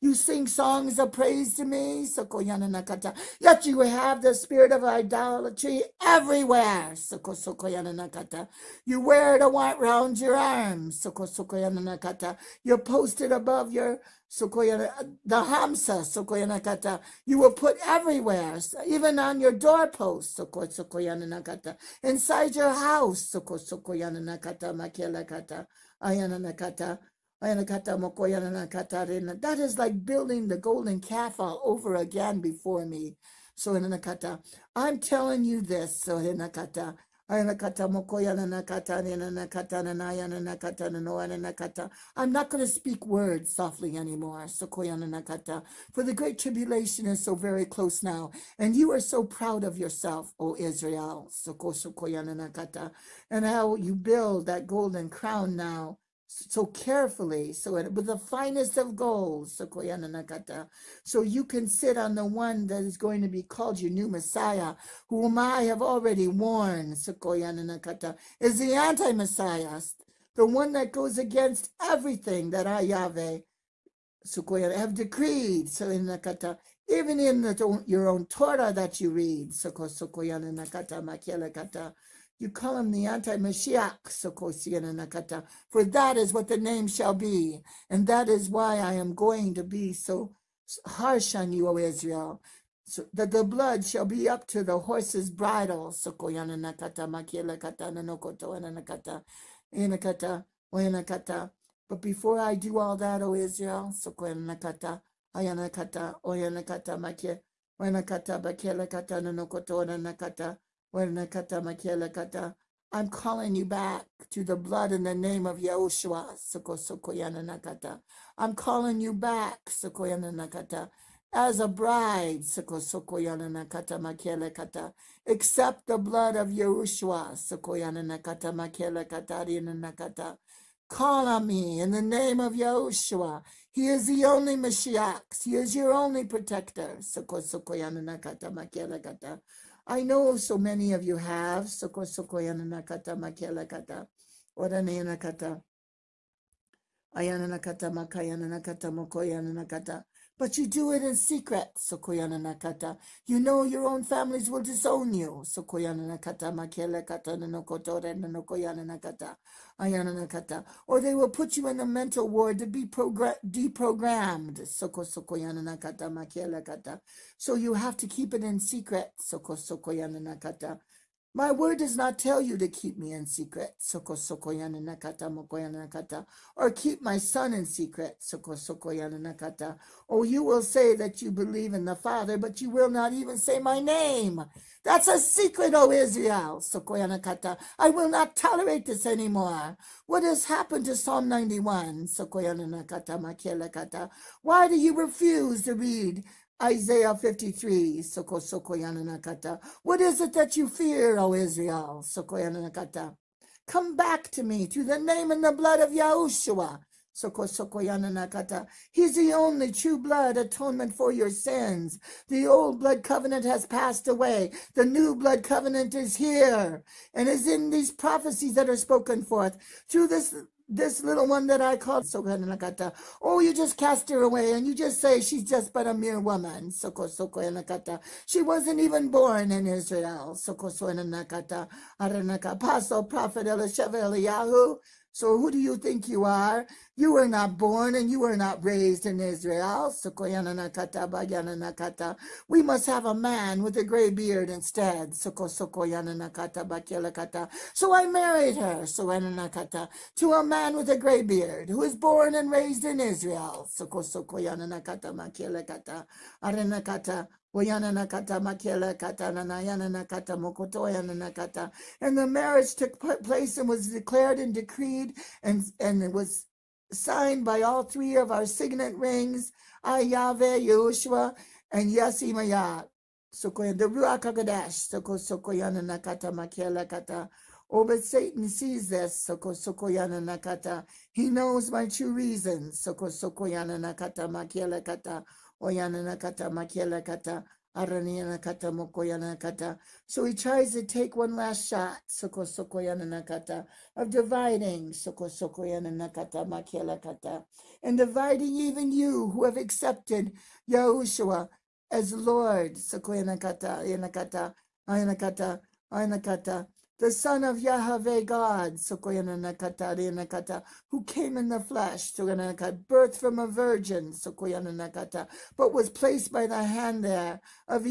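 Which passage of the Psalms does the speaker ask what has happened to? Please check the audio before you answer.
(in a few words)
Psalm 91.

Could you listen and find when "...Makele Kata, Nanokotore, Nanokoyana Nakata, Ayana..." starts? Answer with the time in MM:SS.
02:36.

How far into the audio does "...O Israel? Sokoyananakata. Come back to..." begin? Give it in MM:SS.
03:21.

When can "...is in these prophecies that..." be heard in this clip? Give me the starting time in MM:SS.
03:37.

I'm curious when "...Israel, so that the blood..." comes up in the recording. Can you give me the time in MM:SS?
01:31.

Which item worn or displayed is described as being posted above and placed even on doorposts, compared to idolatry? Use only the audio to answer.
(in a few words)
The hamsa.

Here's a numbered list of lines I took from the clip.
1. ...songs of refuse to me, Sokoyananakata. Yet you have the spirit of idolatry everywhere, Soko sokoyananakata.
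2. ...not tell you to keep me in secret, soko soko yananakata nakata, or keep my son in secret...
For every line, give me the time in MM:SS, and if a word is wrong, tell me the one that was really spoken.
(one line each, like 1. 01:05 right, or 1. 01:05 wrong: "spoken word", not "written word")
1. 00:00 wrong: "praise", not "refuse"
2. 02:51 right.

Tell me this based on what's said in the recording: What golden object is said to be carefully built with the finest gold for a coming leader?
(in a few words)
Golden crown.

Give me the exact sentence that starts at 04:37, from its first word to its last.
Oh, but Satan sees this, Soko Sokoyan Nakata.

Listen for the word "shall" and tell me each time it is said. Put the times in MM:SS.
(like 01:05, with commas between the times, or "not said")
01:26, 01:33.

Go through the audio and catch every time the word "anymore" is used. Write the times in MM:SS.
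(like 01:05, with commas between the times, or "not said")
00:43, 03:09.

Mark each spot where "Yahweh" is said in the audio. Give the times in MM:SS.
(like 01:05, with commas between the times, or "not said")
01:12, 05:07.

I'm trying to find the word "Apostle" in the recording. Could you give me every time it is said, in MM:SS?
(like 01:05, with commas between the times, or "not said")
03:52.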